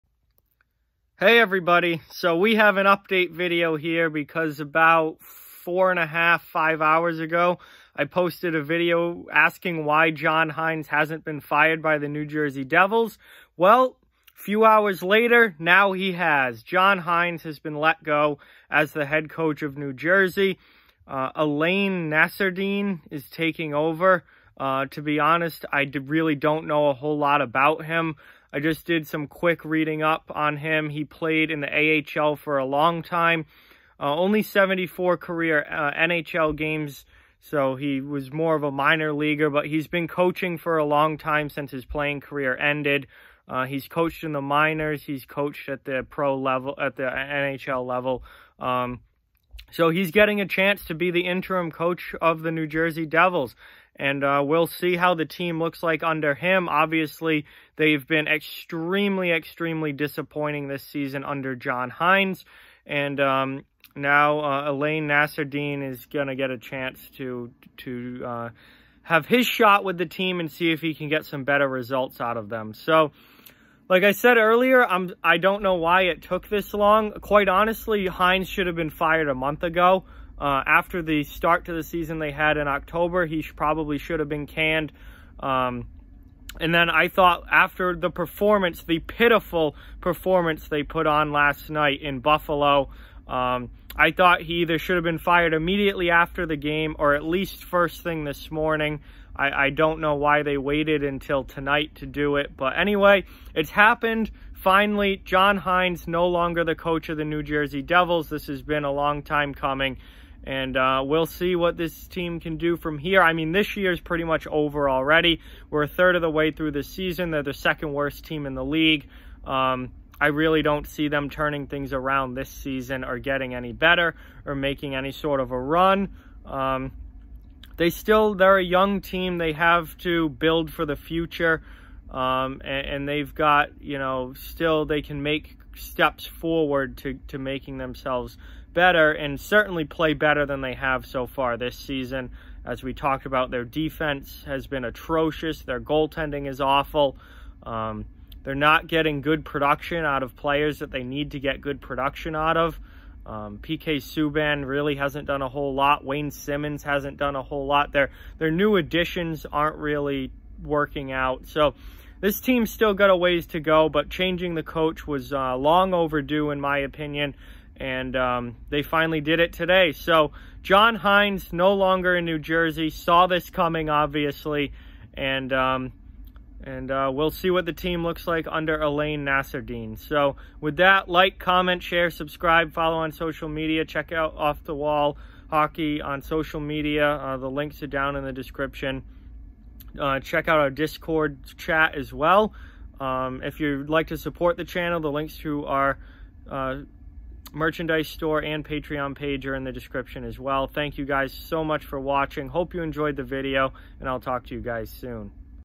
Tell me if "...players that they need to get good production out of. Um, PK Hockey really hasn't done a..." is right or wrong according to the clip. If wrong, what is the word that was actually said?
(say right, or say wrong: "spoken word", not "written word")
wrong: "Subban", not "Hockey".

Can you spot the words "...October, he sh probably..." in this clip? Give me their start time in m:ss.
1:22.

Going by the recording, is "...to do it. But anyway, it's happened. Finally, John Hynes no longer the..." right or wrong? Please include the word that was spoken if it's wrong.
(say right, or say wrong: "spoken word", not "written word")
right.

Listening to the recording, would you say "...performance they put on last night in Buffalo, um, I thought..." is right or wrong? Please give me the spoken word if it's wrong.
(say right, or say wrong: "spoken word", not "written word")
right.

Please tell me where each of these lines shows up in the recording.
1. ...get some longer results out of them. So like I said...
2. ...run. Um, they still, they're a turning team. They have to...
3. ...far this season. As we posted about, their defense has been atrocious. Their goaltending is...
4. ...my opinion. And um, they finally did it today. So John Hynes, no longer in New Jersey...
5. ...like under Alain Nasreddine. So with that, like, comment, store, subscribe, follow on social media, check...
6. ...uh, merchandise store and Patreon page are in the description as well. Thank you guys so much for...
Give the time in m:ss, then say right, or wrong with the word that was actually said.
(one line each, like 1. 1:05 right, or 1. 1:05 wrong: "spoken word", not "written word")
1. 1:11 wrong: "better", not "longer"
2. 2:05 wrong: "young", not "turning"
3. 2:21 wrong: "talked", not "posted"
4. 2:46 right
5. 2:58 wrong: "share", not "store"
6. 3:16 right.